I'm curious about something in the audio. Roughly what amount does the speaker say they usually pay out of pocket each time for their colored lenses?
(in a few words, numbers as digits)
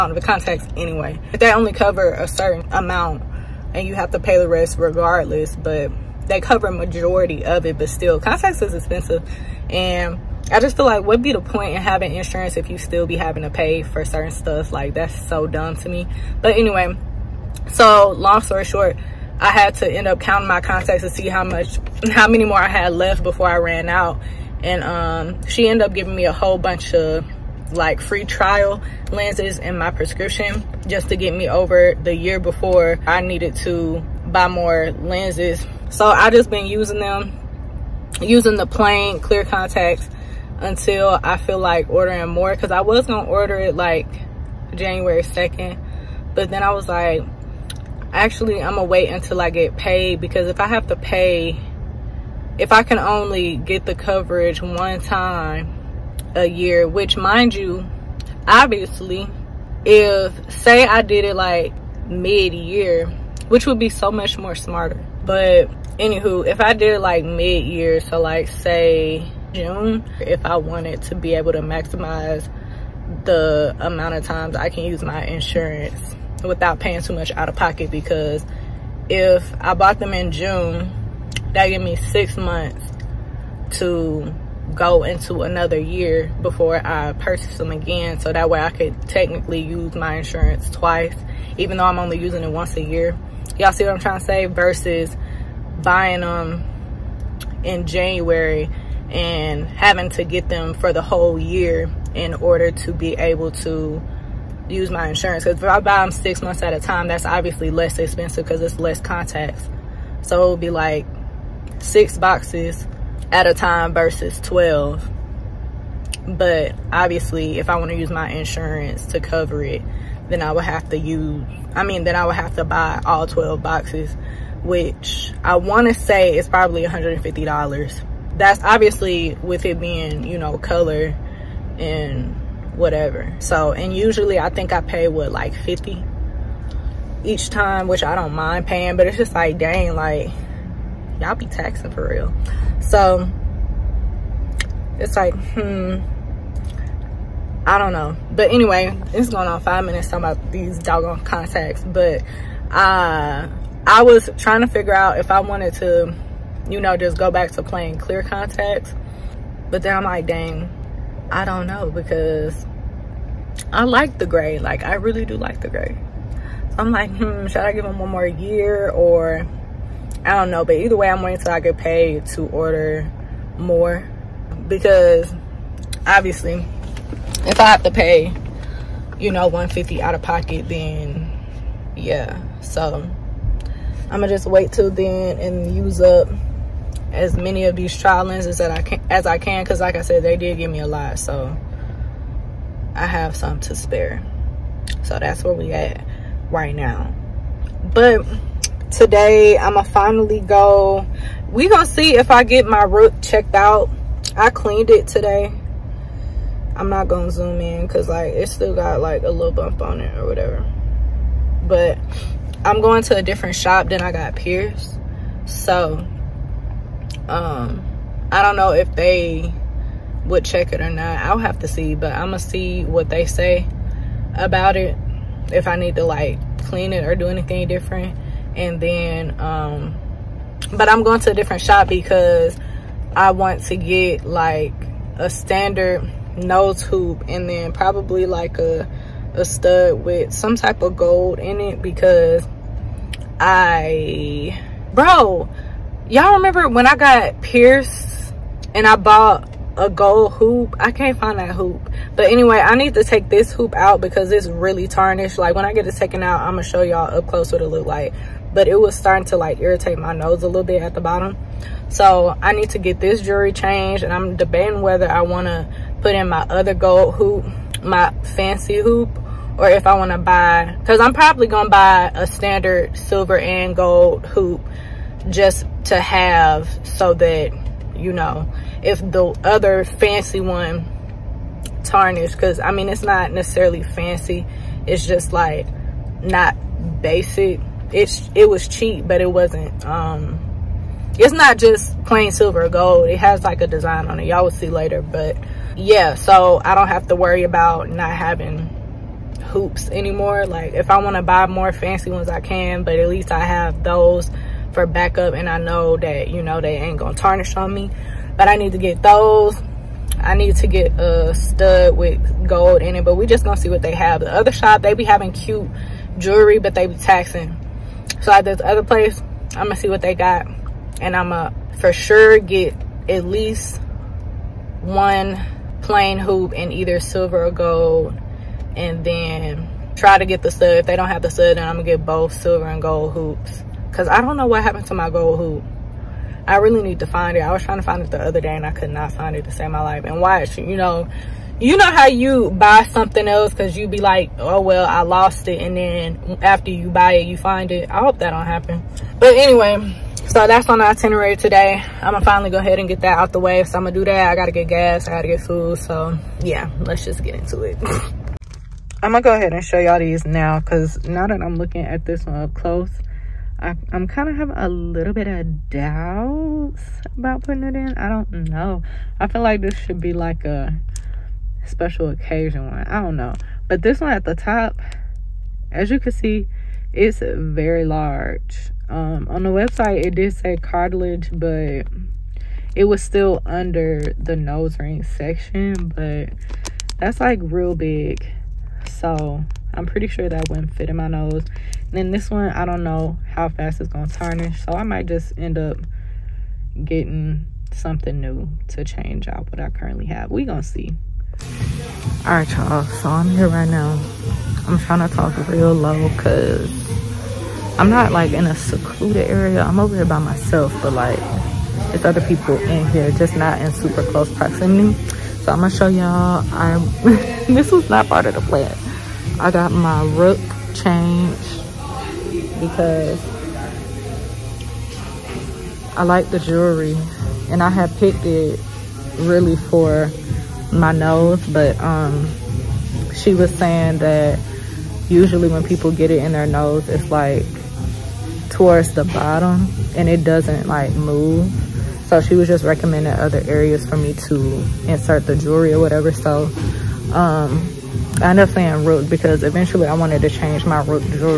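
$50.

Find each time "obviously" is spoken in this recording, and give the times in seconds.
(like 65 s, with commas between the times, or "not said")
58 s, 107 s, 116 s, 128 s, 176 s.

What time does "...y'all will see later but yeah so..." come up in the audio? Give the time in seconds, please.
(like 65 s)
294 s.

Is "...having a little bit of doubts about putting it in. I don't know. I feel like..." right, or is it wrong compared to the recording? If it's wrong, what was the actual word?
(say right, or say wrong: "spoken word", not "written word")
right.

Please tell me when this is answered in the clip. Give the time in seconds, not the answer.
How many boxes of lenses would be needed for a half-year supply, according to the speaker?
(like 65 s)
111 s.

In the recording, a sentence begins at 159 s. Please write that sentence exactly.
But then I'm like, dang, I don't know because I like the gray.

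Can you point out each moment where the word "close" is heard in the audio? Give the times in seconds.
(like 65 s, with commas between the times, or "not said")
257 s, 362 s, 414 s.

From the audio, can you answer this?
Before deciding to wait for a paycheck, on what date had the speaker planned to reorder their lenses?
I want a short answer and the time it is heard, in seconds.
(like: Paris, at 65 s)
January 2nd, at 44 s.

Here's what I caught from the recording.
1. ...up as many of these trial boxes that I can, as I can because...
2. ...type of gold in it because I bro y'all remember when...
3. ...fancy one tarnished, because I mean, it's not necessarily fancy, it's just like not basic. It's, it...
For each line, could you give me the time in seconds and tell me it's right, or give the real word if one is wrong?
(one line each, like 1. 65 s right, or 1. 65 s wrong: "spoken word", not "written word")
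1. 186 s wrong: "lenses", not "boxes"
2. 240 s right
3. 279 s right.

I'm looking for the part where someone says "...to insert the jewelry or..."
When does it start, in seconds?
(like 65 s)
444 s.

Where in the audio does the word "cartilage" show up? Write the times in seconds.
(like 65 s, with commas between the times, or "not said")
380 s.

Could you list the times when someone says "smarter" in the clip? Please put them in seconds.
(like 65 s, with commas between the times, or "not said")
64 s.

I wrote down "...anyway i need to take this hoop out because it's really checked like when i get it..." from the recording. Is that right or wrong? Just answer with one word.
wrong.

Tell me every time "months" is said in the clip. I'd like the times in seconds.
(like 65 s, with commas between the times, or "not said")
82 s, 106 s.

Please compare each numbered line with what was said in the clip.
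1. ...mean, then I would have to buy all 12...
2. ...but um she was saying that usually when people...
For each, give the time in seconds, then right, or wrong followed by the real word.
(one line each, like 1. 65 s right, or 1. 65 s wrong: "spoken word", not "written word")
1. 121 s right
2. 431 s right.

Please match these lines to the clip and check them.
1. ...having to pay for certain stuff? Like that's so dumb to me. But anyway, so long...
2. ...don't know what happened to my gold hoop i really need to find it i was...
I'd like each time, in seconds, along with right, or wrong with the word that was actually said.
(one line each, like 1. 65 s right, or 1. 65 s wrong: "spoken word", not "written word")
1. 13 s right
2. 334 s right.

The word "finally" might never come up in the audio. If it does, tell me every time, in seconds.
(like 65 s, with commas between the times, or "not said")
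199 s, 352 s.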